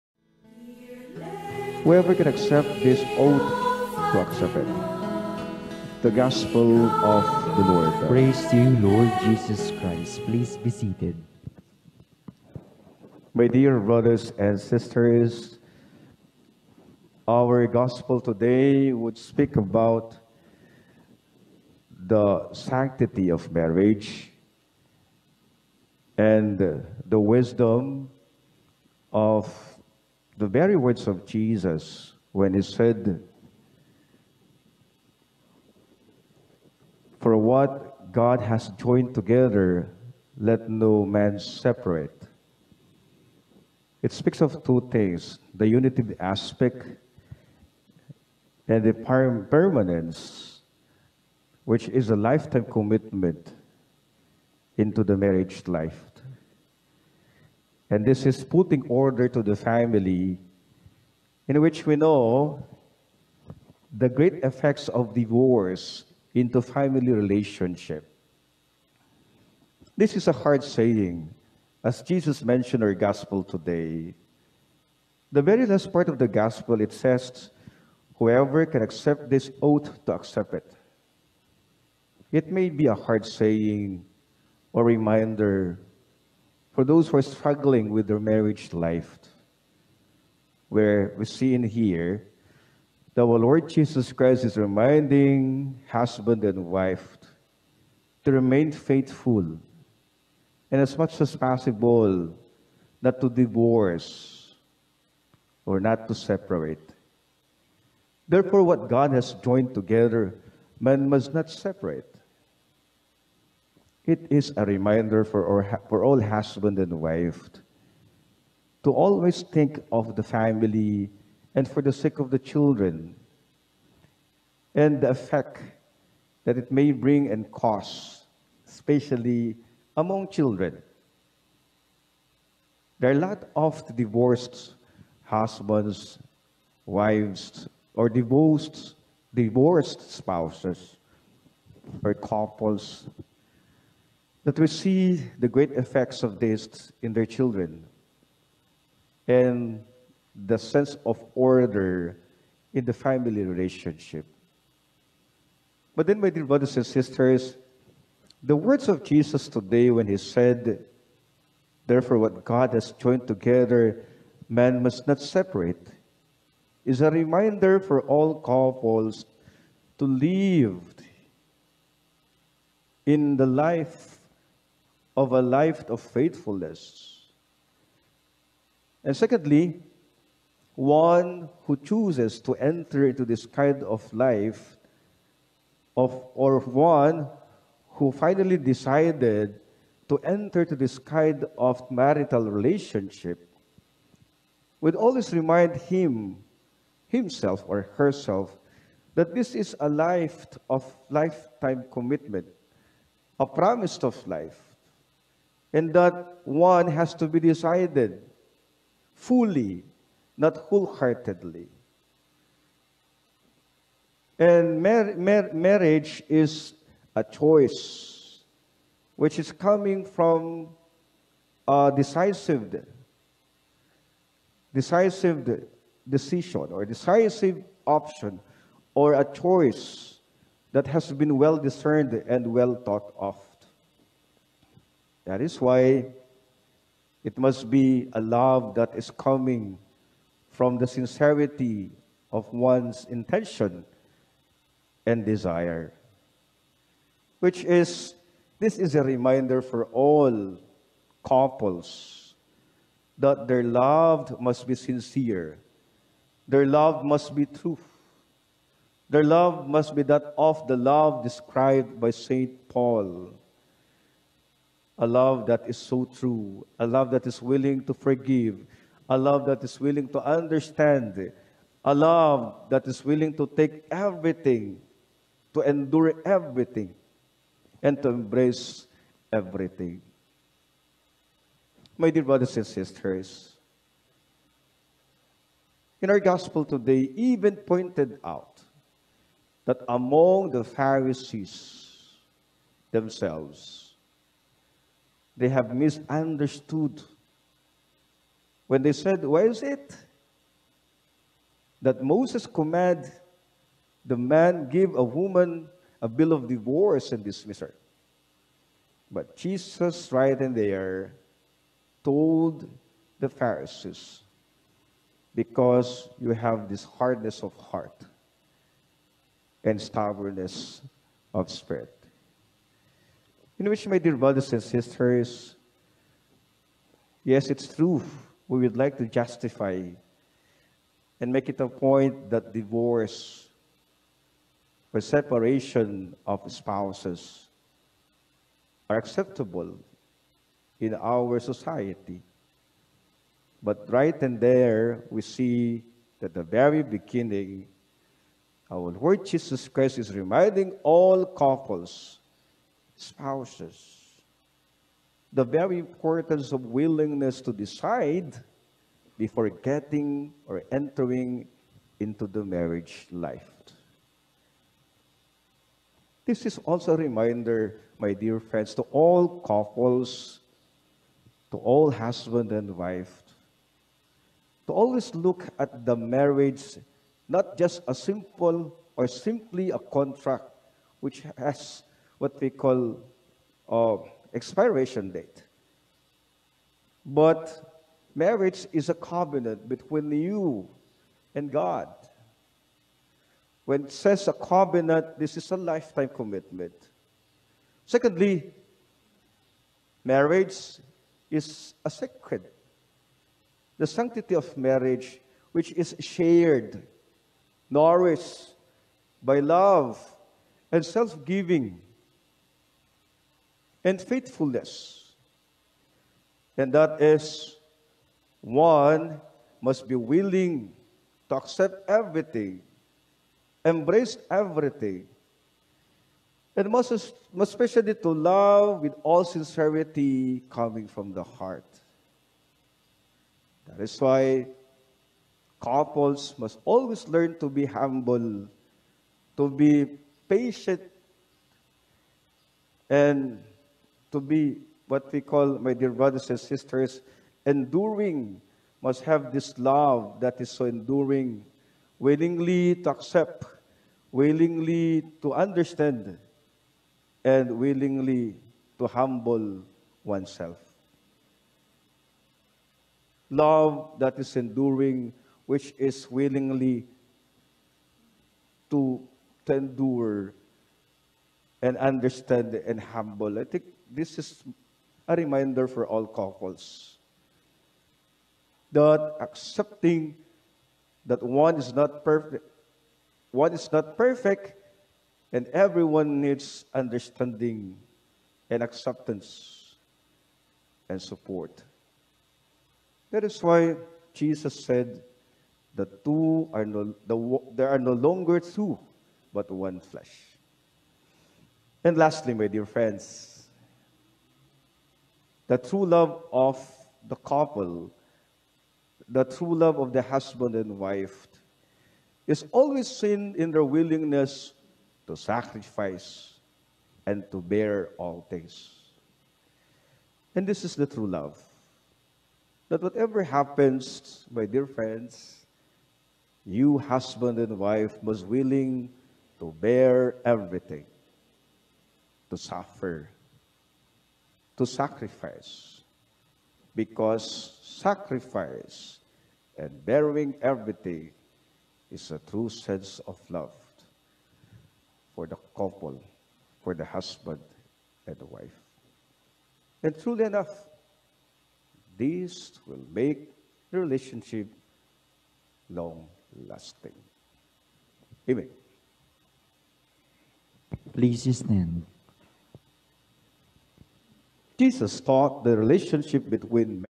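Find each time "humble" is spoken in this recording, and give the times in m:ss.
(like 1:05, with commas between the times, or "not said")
7:17, 7:38, 7:52.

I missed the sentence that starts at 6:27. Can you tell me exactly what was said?
But marriage is a covenant between you and God.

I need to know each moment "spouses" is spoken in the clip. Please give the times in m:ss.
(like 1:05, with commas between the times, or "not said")
2:20, 5:36, 5:53.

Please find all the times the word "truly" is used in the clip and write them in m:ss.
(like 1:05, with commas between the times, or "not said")
9:09.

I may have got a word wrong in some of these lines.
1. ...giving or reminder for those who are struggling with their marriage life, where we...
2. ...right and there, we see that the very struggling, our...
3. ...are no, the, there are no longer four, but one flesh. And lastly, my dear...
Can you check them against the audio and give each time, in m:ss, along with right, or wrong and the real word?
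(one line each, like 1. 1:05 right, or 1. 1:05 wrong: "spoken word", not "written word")
1. 1:23 wrong: "saying", not "giving"
2. 5:43 wrong: "beginning", not "struggling"
3. 8:16 wrong: "two", not "four".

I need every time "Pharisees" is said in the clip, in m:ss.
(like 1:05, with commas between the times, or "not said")
4:50, 5:13.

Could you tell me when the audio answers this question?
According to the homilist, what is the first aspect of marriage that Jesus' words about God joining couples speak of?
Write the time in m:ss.
0:45.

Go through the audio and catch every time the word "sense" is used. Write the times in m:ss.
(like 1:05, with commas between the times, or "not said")
2:30, 9:02.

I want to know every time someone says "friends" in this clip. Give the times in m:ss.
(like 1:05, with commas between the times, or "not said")
6:08, 8:22, 8:44.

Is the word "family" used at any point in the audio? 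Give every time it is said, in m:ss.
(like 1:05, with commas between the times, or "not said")
0:59, 1:06, 2:00, 2:32.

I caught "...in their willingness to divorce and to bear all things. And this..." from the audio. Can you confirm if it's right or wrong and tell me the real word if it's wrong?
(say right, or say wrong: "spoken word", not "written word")
wrong: "sacrifice", not "divorce".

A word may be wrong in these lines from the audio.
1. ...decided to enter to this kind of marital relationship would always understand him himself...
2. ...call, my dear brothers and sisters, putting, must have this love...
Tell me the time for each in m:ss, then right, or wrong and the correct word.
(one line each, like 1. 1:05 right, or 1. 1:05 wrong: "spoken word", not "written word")
1. 3:08 wrong: "remind", not "understand"
2. 7:25 wrong: "enduring", not "putting".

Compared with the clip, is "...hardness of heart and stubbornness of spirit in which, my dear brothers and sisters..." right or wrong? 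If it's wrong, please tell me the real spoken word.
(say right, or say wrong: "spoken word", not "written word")
right.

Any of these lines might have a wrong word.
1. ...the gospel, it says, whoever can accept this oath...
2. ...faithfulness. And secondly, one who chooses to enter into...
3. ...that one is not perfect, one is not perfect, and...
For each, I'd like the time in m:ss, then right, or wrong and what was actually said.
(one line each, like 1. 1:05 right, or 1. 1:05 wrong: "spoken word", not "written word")
1. 1:16 right
2. 2:55 right
3. 8:01 right.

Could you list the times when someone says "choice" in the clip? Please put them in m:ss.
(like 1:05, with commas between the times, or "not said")
3:37, 3:49.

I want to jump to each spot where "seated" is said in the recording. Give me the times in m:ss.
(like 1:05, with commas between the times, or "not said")
0:10.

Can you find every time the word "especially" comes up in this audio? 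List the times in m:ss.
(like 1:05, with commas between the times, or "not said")
2:08, 7:07.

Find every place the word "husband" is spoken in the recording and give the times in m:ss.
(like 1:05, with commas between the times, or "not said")
1:35, 1:56, 2:15, 6:11, 8:30, 8:46, 9:06.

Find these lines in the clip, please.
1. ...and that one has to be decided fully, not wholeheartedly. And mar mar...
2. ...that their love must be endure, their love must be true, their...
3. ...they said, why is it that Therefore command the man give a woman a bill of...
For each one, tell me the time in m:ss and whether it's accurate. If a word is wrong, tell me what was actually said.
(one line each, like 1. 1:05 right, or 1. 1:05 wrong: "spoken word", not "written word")
1. 3:25 right
2. 4:13 wrong: "sincere", not "endure"
3. 4:58 wrong: "Moses", not "Therefore".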